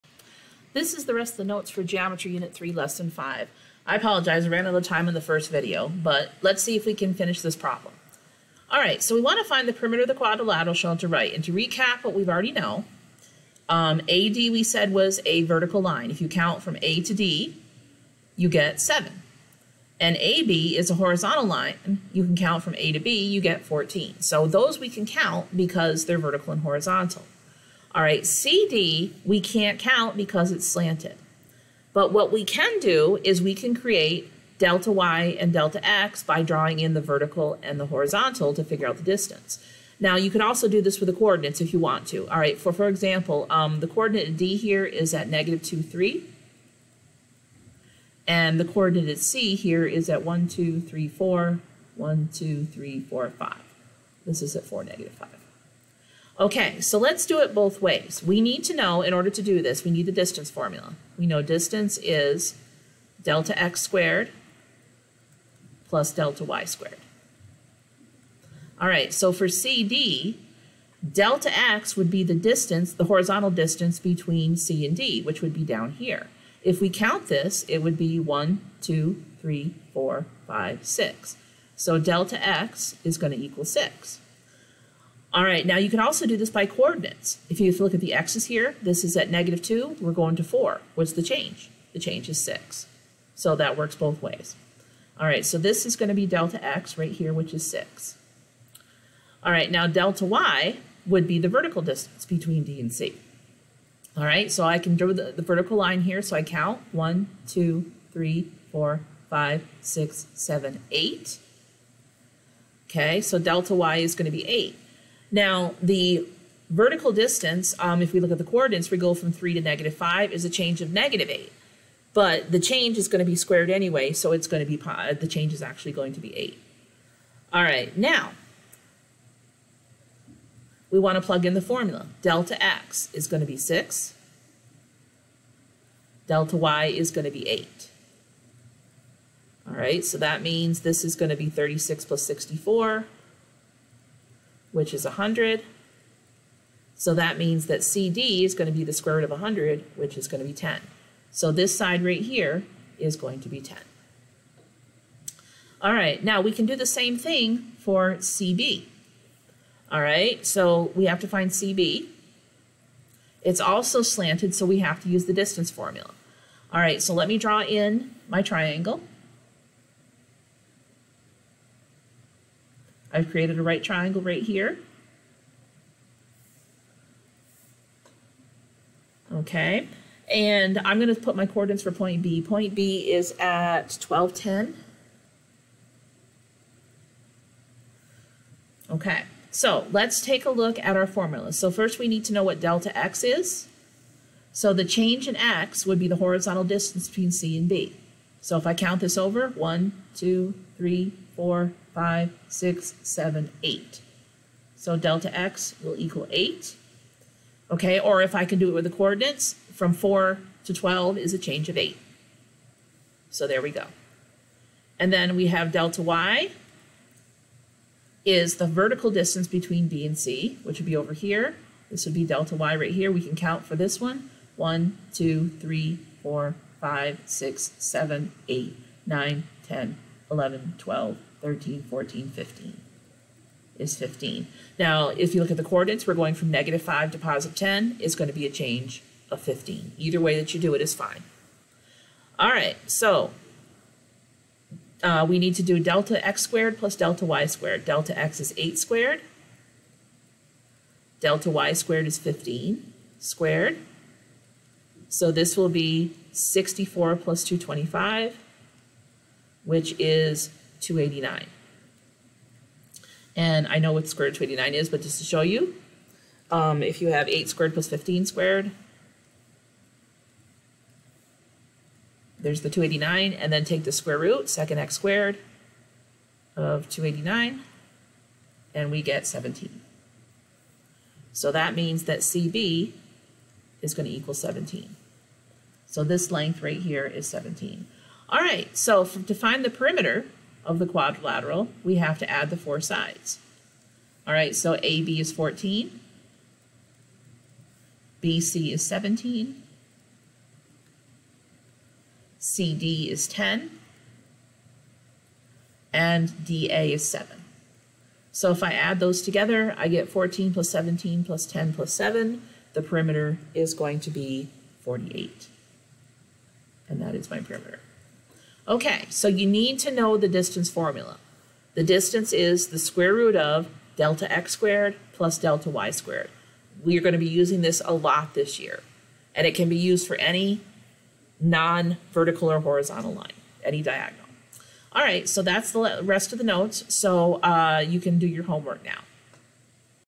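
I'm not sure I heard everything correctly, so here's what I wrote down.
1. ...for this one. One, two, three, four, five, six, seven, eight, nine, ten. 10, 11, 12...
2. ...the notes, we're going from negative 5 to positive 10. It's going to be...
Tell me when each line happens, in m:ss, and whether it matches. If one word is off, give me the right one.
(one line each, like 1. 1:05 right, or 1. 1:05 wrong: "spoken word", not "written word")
1. 3:43 right
2. 3:55 wrong: "coordinates", not "notes".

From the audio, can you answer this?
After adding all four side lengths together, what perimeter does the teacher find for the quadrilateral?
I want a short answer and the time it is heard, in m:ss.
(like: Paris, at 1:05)
48, at 5:14.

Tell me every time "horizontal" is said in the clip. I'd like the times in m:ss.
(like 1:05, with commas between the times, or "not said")
0:20, 0:26, 0:37, 1:13, 3:16, 5:32.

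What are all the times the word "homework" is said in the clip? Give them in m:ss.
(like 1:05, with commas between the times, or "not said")
5:38.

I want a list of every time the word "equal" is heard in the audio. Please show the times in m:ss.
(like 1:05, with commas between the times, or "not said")
1:23, 3:25, 4:44.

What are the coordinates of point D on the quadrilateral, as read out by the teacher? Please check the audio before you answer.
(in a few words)
(-2, 3).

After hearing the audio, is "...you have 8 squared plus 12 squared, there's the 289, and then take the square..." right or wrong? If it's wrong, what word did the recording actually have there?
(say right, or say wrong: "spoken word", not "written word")
wrong: "15", not "12".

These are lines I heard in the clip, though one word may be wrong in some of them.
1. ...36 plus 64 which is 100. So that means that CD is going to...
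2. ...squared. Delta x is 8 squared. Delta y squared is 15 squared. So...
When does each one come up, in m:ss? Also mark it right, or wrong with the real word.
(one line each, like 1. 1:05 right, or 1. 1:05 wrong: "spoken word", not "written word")
1. 2:21 right
2. 4:07 right.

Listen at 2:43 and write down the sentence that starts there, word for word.
It's also slanted, so we have to use the distance formula.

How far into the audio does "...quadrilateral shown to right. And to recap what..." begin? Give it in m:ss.
0:10.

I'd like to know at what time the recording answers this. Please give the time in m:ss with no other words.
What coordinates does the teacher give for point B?
3:04.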